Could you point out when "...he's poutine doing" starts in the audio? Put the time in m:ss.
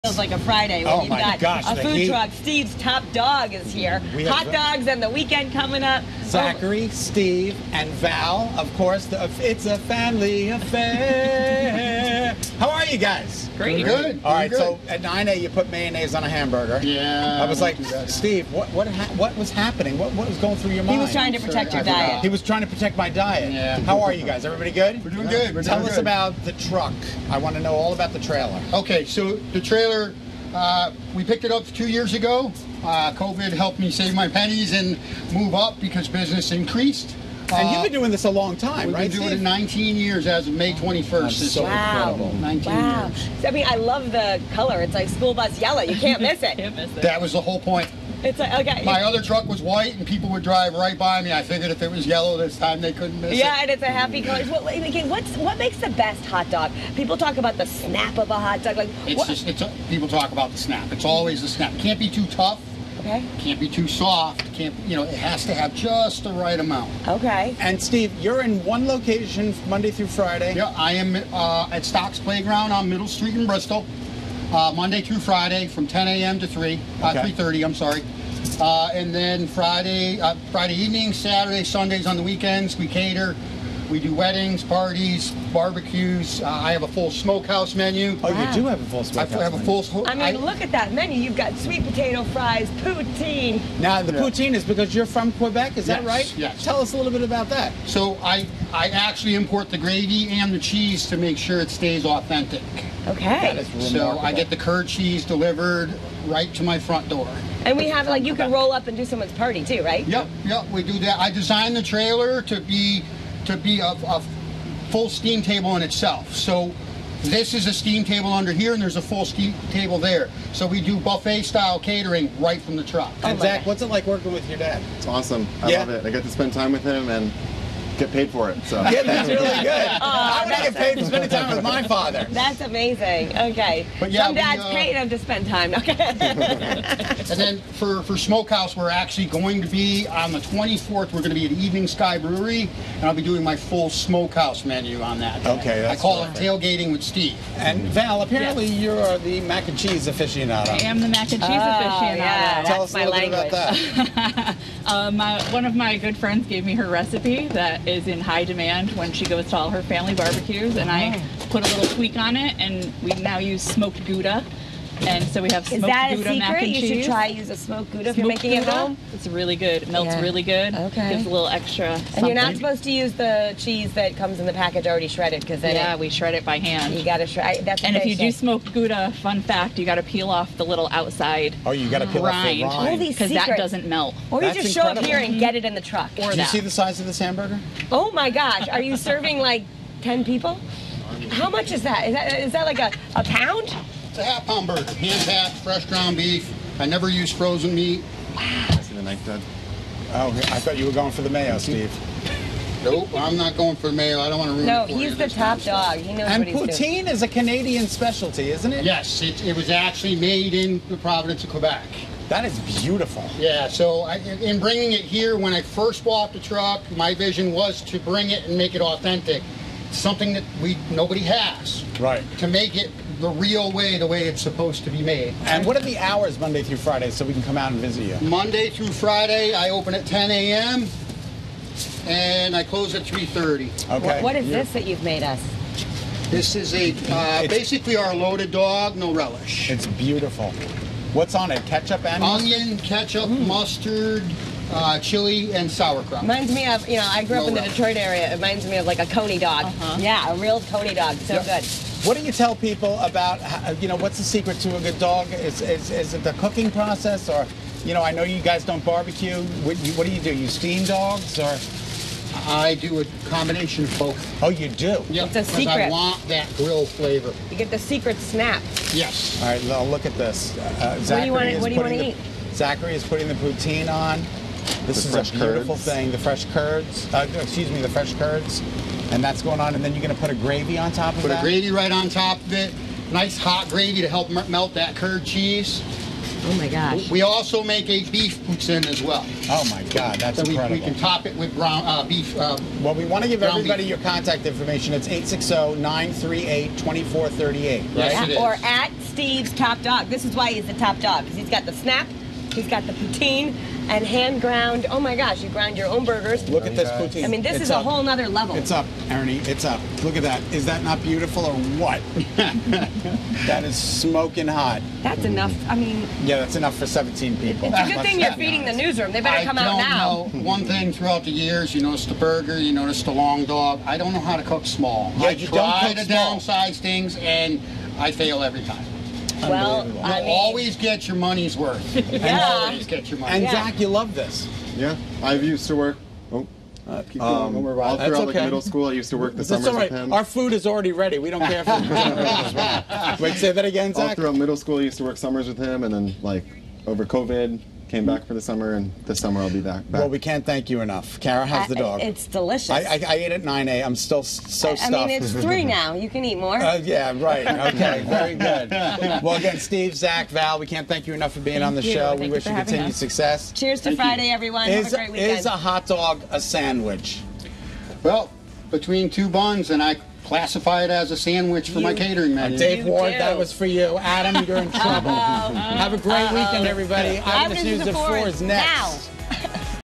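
3:26.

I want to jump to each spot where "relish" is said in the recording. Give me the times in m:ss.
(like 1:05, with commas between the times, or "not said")
3:59, 4:07.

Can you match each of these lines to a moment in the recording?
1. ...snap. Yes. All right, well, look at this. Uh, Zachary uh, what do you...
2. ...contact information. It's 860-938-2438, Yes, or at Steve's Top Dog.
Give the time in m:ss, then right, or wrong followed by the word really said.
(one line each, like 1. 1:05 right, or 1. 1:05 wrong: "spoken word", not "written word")
1. 4:28 right
2. 4:53 right.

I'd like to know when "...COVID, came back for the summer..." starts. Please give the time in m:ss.
5:47.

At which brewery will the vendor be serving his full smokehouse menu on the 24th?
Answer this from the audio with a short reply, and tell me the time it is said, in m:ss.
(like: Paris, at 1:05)
Evening Sky Brewery, at 2:21.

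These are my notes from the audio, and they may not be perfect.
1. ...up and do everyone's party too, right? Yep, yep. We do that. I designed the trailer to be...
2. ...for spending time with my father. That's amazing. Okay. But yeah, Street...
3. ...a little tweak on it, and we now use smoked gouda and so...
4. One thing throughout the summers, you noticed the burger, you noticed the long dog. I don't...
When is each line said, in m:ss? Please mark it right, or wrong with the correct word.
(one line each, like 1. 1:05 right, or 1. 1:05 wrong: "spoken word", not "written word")
1. 1:48 wrong: "someone", not "everyone"
2. 2:10 wrong: "Some", not "Street"
3. 2:41 right
4. 5:20 wrong: "years", not "summers".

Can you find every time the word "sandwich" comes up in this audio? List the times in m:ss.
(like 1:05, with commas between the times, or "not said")
6:06, 6:11.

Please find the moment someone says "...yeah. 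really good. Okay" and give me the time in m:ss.
2:50.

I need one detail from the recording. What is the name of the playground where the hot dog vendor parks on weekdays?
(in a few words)
Stocks Playground.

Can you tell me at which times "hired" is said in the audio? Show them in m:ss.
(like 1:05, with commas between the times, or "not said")
not said.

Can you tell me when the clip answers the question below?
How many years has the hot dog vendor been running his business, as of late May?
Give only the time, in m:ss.
0:39.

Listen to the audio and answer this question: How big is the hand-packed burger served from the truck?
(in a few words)
Half pound.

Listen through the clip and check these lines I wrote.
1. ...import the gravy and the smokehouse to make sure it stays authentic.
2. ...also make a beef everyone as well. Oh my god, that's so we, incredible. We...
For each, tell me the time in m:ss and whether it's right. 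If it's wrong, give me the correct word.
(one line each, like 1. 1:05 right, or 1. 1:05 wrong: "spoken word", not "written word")
1. 1:39 wrong: "cheese", not "smokehouse"
2. 4:47 wrong: "poutine", not "everyone".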